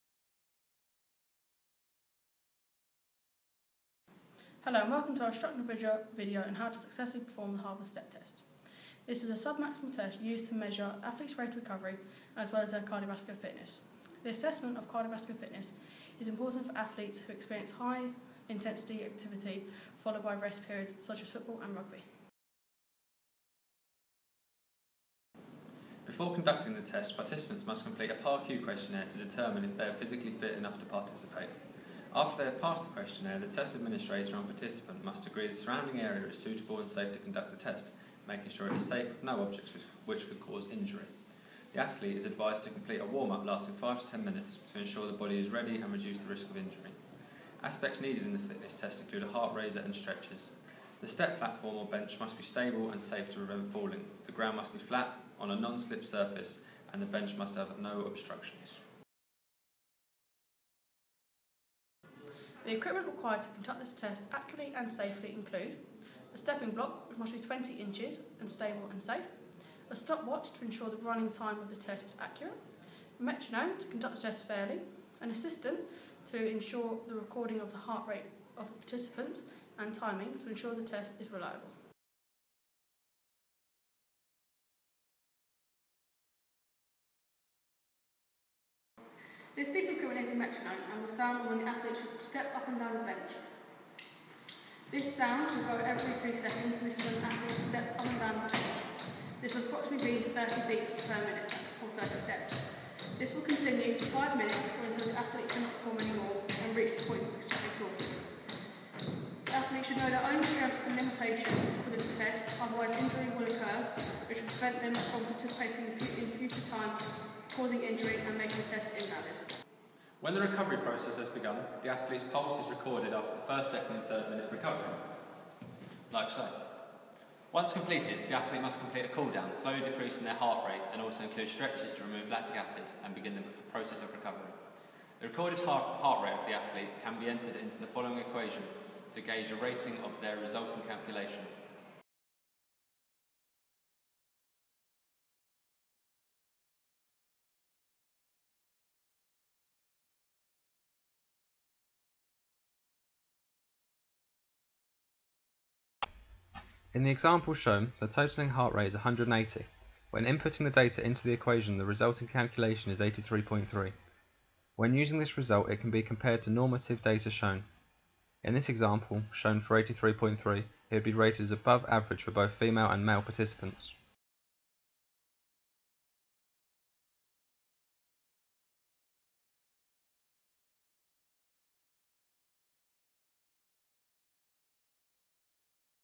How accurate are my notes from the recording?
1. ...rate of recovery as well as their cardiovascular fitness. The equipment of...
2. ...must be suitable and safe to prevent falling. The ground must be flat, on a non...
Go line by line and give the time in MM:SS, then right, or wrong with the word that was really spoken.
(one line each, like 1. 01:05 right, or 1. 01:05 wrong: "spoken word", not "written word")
1. 00:11 wrong: "assessment", not "equipment"
2. 00:52 wrong: "stable", not "suitable".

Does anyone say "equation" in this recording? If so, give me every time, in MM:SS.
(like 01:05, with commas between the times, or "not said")
02:18, 02:41.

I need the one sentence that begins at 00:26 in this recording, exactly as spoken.
Before conducting the test, participants must complete a PARQ questionnaire to determine if they are physically fit enough to participate.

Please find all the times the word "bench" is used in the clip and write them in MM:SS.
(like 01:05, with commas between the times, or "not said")
00:51, 00:57, 01:32, 01:38.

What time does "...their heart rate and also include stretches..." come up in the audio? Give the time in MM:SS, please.
02:10.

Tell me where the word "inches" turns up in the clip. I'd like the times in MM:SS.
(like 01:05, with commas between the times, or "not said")
01:07.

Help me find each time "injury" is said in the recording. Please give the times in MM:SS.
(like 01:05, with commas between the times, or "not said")
00:40, 00:46, 01:52, 01:57.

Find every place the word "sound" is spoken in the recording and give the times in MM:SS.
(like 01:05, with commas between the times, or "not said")
01:31, 01:35.